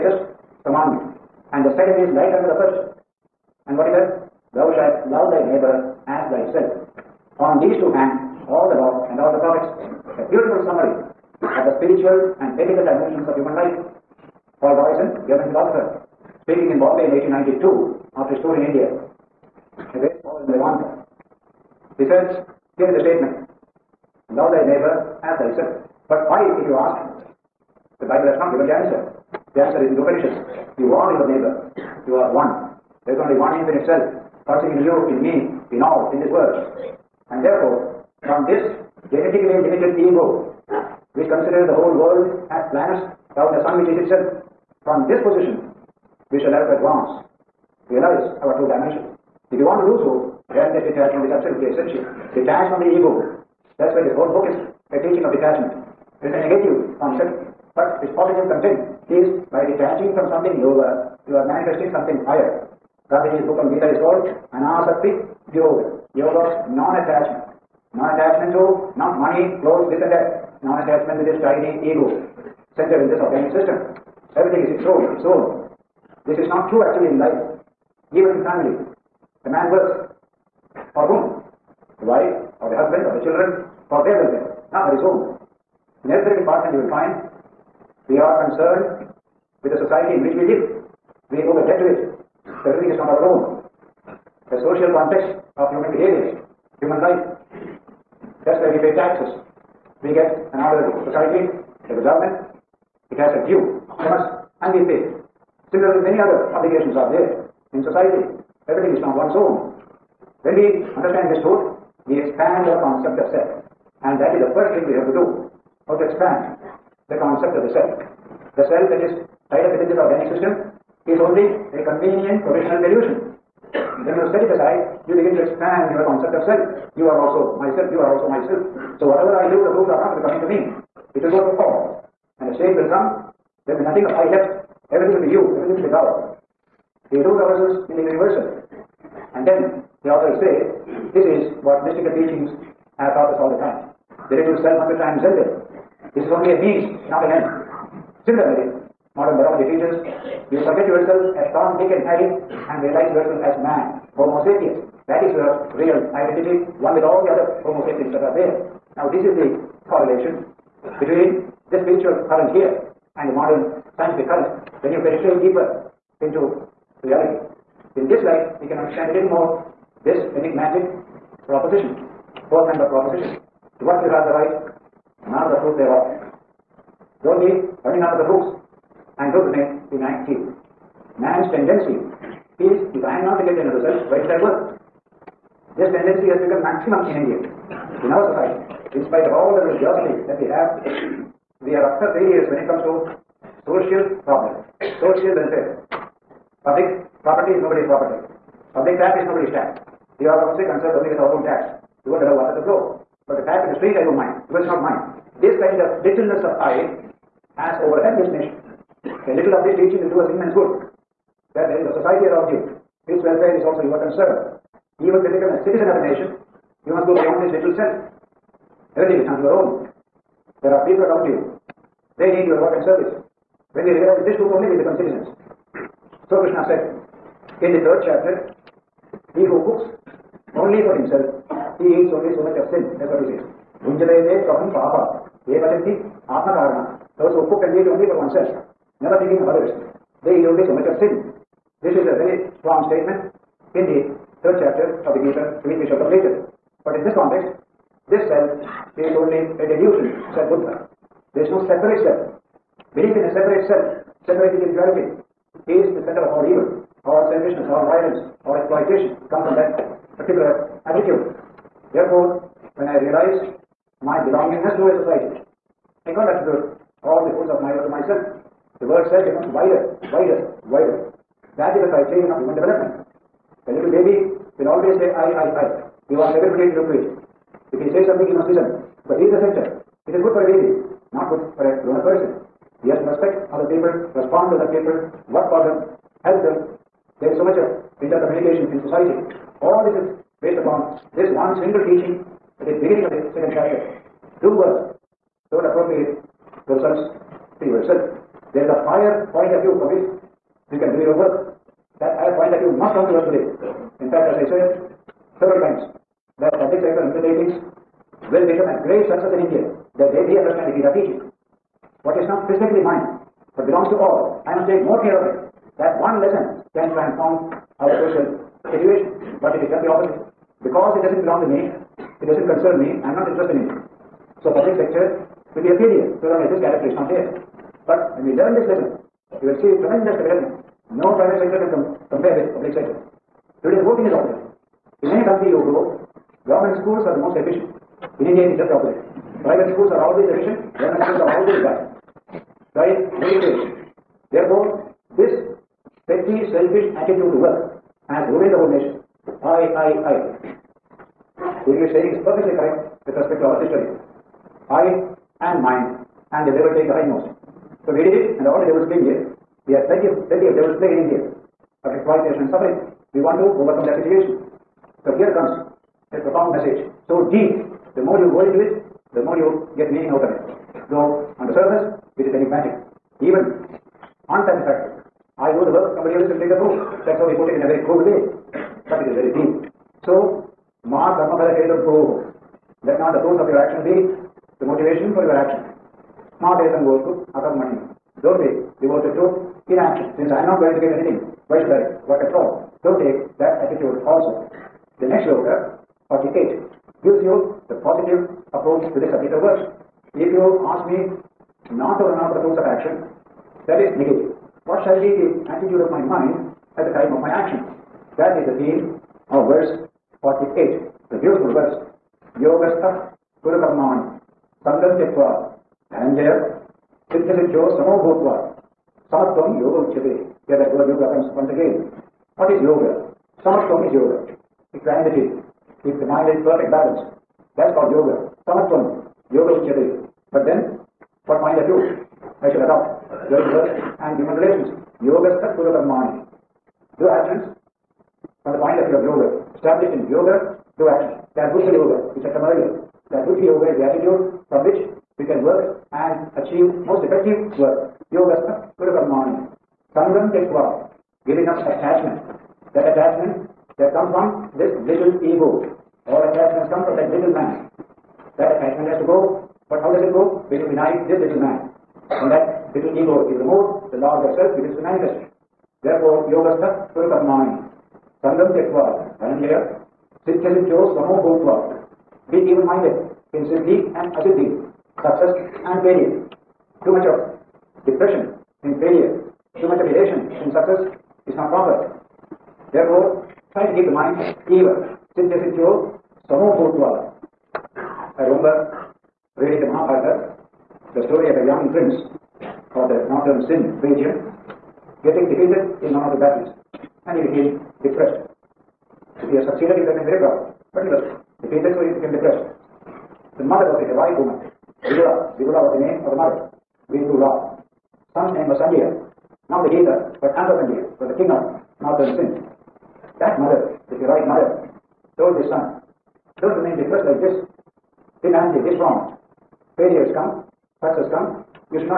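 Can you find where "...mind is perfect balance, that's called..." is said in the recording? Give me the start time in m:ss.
7:06.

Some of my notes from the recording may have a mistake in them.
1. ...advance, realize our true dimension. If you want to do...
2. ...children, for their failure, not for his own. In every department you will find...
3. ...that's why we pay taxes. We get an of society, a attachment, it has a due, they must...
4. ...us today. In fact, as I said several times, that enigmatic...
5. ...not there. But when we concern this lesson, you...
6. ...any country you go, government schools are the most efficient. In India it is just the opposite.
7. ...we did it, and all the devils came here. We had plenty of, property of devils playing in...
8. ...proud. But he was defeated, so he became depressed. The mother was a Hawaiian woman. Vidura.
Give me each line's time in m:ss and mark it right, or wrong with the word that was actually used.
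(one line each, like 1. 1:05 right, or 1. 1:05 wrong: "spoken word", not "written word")
1. 0:46 right
2. 1:23 wrong: "welfare", not "failure"
3. 1:38 wrong: "government", not "attachment"
4. 5:03 wrong: "public", not "enigmatic"
5. 5:26 wrong: "learn", not "concern"
6. 5:35 right
7. 5:57 wrong: "plenty", not "property"
8. 8:20 right.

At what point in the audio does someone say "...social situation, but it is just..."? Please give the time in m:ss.
5:18.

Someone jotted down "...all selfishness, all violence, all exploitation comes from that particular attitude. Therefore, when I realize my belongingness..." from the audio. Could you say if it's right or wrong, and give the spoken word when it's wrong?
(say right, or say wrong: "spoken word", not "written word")
right.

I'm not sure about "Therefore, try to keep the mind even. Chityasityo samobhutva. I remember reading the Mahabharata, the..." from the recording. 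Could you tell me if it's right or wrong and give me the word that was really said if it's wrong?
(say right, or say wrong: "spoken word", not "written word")
right.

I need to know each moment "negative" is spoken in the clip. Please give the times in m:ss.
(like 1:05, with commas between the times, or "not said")
0:56, 6:43.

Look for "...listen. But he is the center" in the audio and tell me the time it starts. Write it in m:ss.
4:38.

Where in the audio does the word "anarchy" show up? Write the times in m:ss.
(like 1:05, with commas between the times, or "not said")
8:38.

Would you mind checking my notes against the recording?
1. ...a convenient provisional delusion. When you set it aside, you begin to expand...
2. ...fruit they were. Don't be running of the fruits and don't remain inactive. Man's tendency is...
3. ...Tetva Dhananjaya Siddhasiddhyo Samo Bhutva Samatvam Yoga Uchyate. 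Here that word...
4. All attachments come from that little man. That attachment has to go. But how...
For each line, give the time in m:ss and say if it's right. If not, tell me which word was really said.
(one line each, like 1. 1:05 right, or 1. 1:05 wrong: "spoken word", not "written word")
1. 2:01 right
2. 2:55 right
3. 6:54 right
4. 7:36 right.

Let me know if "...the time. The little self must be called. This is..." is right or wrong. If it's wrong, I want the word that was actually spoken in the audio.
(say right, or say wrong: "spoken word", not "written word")
wrong: "transcended", not "called".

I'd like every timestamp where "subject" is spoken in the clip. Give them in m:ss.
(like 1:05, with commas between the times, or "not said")
6:39.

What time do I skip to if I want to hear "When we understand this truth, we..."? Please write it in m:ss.
1:50.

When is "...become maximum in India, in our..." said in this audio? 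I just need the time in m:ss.
3:06.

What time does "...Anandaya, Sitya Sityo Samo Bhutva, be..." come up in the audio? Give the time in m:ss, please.
7:49.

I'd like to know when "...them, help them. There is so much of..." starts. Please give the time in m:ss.
4:45.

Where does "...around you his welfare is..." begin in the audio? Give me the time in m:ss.
3:32.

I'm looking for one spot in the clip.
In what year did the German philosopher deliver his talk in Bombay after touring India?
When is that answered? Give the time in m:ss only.
0:17.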